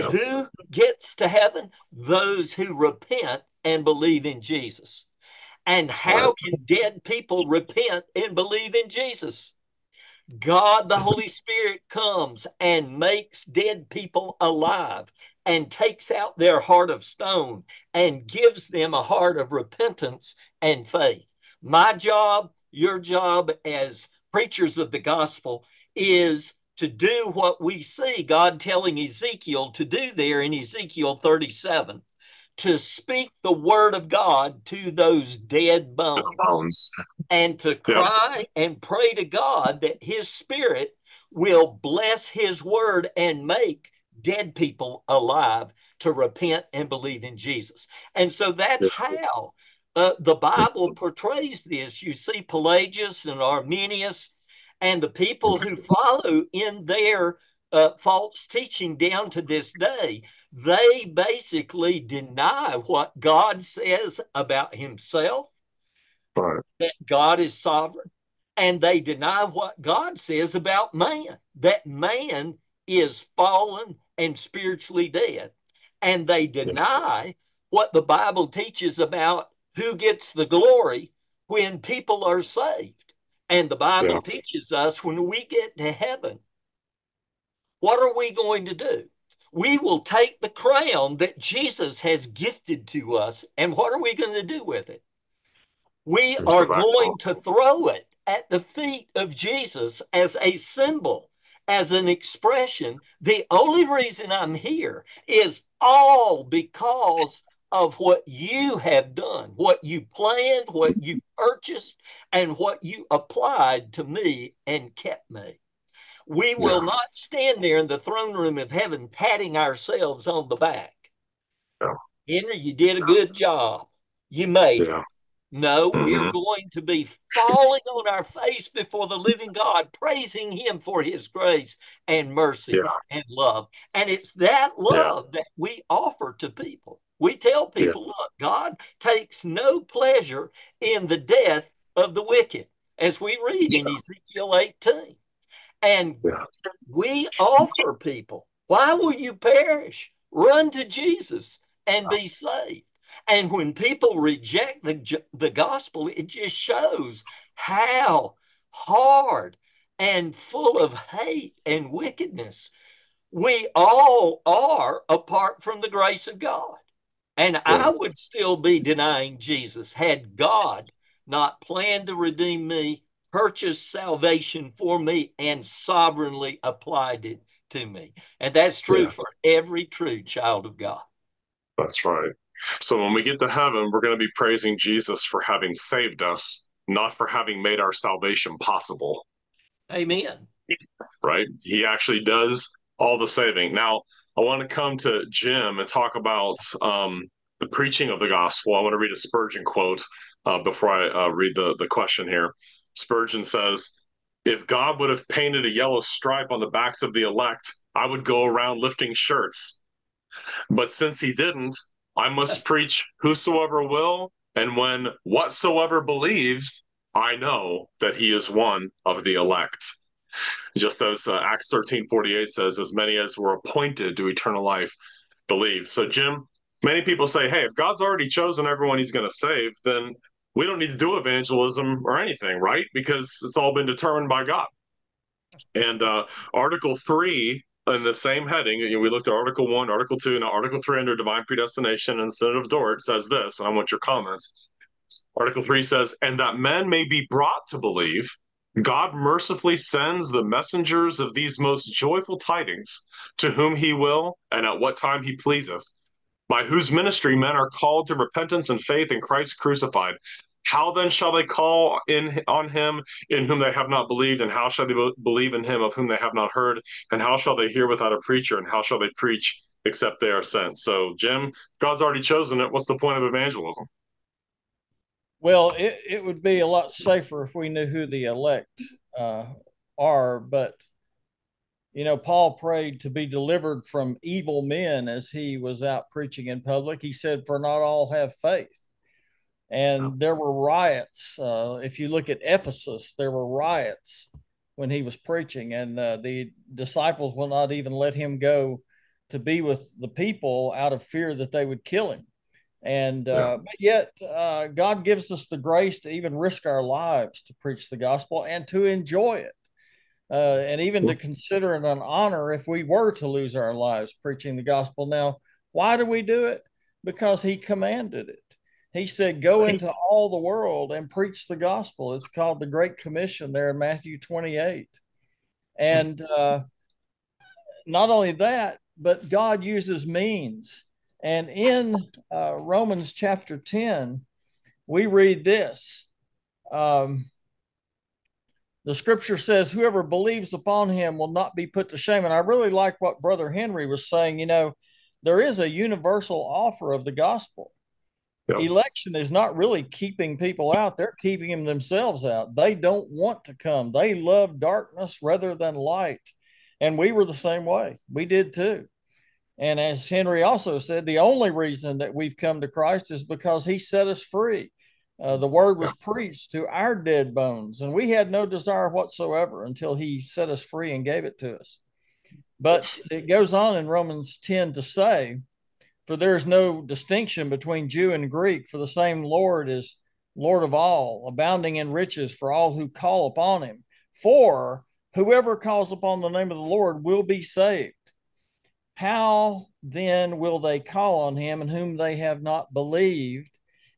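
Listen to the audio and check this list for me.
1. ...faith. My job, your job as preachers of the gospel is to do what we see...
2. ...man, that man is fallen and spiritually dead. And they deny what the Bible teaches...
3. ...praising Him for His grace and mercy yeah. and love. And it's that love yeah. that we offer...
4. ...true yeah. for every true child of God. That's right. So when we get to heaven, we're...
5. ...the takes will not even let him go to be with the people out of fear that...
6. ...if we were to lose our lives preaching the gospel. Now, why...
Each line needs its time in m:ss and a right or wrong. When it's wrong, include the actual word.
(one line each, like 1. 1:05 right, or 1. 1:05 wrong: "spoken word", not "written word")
1. 0:20 right
2. 1:10 right
3. 2:09 right
4. 2:58 right
5. 4:56 wrong: "disciples", not "takes"
6. 5:12 right.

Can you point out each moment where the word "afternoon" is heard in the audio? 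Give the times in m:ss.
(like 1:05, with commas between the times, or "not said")
not said.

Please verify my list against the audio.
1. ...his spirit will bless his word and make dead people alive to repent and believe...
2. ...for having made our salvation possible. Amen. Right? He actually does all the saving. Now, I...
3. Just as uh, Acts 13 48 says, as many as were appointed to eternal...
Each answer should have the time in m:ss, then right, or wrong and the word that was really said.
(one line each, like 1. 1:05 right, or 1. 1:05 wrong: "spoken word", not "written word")
1. 0:40 right
2. 3:07 right
3. 3:40 right.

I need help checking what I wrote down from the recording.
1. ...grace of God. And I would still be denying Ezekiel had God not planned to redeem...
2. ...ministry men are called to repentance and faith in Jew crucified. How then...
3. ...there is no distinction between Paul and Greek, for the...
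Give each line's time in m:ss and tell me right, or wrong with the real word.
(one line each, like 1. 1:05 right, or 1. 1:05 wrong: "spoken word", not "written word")
1. 2:45 wrong: "Jesus", not "Ezekiel"
2. 4:16 wrong: "Christ", not "Jew"
3. 6:16 wrong: "Jew", not "Paul".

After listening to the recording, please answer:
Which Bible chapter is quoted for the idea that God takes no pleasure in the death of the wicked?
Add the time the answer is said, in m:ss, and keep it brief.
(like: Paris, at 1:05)
Ezekiel 18, at 2:23.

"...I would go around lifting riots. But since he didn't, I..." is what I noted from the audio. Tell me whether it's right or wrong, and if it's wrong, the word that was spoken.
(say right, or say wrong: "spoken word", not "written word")
wrong: "shirts", not "riots".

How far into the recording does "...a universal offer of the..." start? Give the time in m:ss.
5:45.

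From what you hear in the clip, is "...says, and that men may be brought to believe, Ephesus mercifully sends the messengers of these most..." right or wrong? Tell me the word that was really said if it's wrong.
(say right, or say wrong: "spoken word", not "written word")
wrong: "God", not "Ephesus".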